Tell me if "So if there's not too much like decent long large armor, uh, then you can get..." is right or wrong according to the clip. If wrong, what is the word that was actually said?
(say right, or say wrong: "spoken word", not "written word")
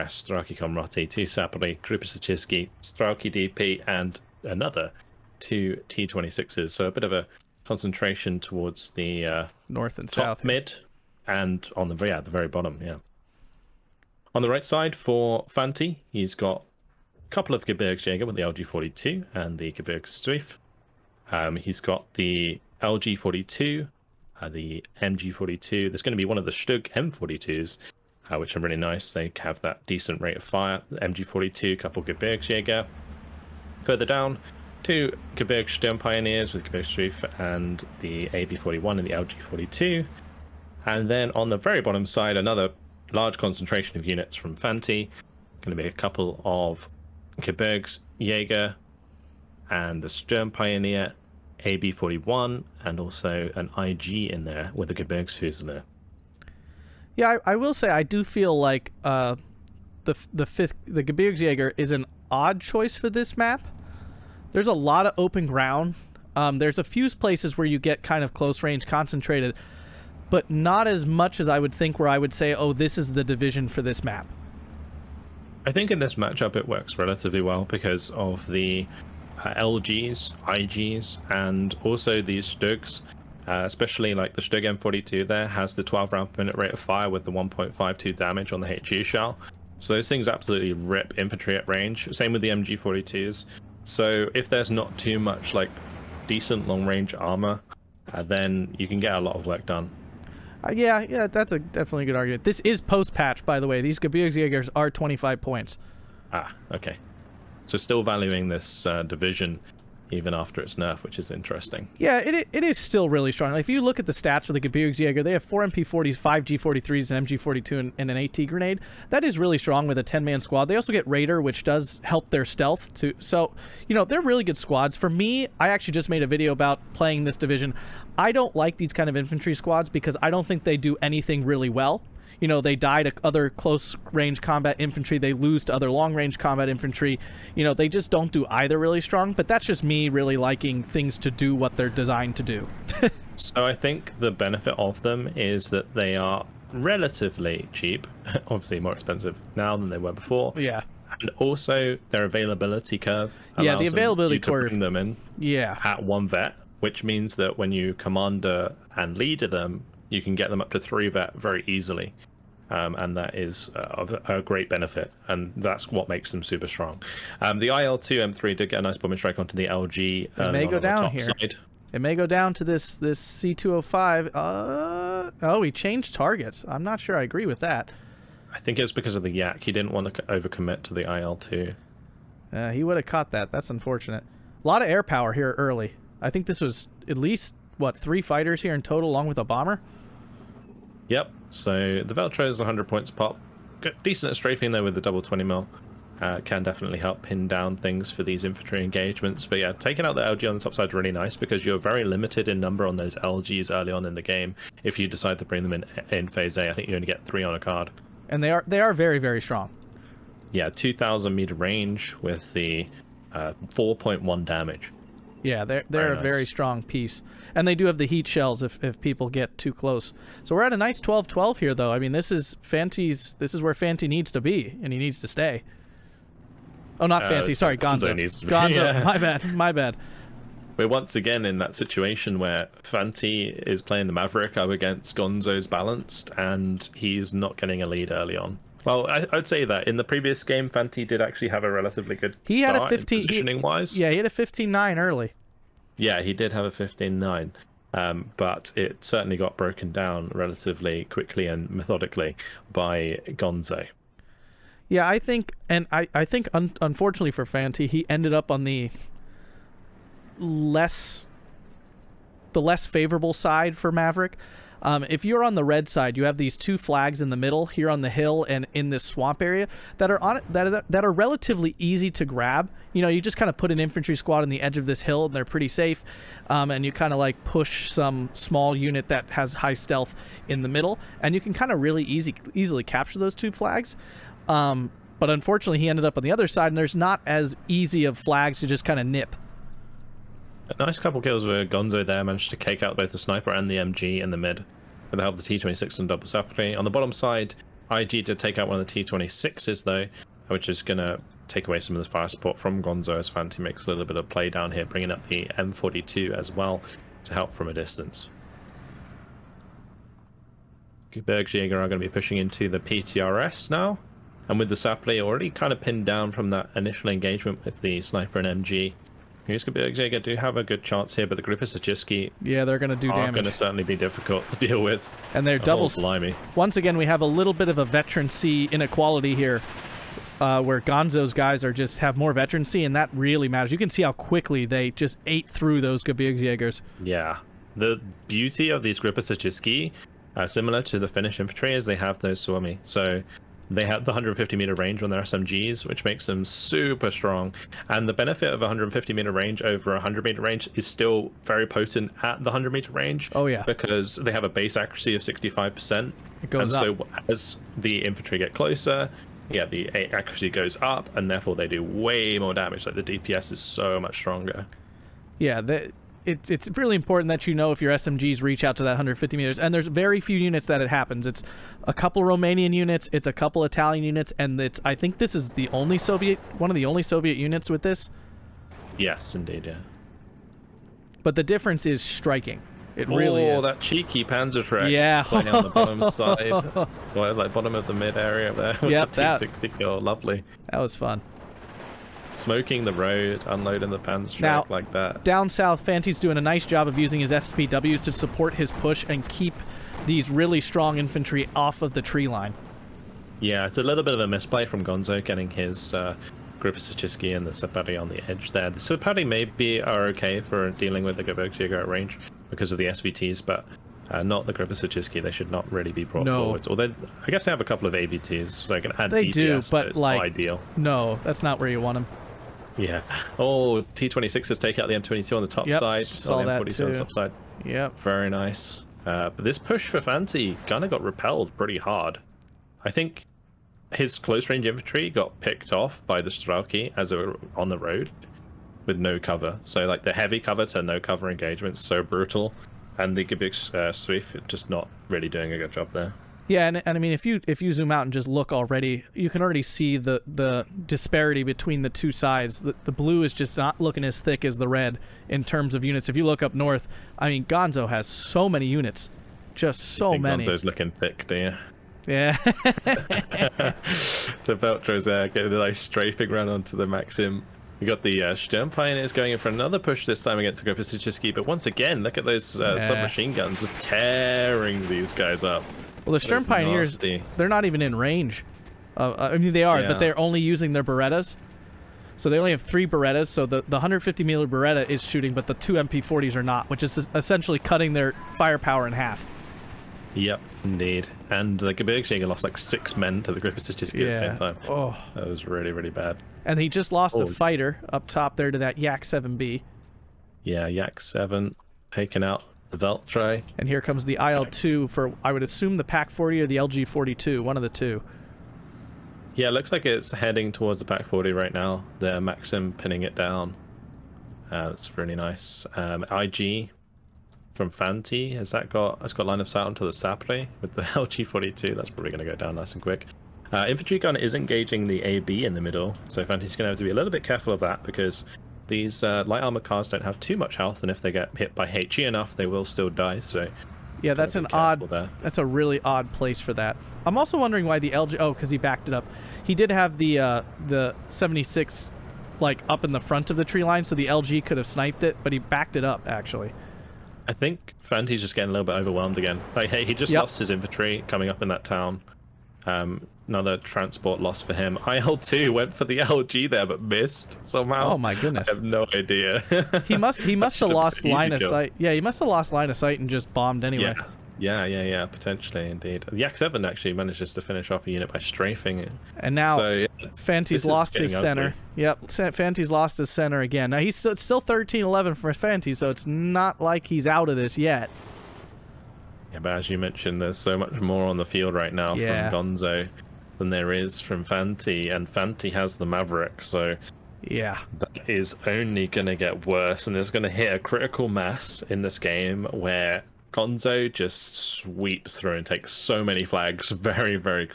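wrong: "range", not "large".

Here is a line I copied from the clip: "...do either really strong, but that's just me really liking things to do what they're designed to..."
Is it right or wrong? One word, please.
right.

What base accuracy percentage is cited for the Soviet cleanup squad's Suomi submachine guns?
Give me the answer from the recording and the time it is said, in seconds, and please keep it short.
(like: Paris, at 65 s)
65%, at 355 s.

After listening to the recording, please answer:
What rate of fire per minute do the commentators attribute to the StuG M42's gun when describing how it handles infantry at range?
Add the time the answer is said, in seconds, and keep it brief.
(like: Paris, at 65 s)
12 rounds per minute, at 85 s.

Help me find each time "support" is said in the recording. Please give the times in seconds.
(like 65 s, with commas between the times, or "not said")
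302 s, 398 s.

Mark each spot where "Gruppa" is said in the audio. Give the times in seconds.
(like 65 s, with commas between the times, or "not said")
1 s, 493 s.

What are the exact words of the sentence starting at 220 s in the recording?
So we're at a nice 12-12 here, though.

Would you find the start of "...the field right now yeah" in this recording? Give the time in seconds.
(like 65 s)
581 s.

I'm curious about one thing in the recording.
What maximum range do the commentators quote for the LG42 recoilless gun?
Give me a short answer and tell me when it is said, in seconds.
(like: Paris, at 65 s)
2,000 meters, at 210 s.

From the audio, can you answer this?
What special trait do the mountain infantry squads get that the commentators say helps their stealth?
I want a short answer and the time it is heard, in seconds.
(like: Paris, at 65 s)
Raider, at 121 s.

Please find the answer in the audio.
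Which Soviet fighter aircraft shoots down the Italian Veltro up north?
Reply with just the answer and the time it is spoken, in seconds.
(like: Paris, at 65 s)
Yak 7B, at 498 s.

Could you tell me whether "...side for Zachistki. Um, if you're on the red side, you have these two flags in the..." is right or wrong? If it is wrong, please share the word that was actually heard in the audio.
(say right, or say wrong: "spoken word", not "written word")
wrong: "Maverick", not "Zachistki".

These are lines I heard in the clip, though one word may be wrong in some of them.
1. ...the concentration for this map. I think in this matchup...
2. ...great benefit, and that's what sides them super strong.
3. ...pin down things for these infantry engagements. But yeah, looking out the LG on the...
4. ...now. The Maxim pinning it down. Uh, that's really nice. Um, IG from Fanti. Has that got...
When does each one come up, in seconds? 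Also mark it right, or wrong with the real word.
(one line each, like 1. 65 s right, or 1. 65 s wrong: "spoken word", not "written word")
1. 73 s wrong: "division", not "concentration"
2. 164 s wrong: "makes", not "sides"
3. 197 s wrong: "taking", not "looking"
4. 511 s right.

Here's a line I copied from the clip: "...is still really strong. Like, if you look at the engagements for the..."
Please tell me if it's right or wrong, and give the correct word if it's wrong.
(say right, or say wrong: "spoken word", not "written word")
wrong: "stats", not "engagements".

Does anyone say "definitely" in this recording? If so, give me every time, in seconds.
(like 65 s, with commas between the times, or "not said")
101 s, 196 s.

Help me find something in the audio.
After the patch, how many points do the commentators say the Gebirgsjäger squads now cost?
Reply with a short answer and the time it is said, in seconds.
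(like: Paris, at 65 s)
25 points, at 104 s.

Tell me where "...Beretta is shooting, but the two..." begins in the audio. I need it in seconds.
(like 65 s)
484 s.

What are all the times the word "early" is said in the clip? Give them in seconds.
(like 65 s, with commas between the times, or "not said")
185 s, 203 s, 238 s, 244 s.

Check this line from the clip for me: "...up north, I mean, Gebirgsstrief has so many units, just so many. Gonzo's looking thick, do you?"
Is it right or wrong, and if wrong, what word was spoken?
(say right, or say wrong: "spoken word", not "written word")
wrong: "Gonzo", not "Gebirgsstrief".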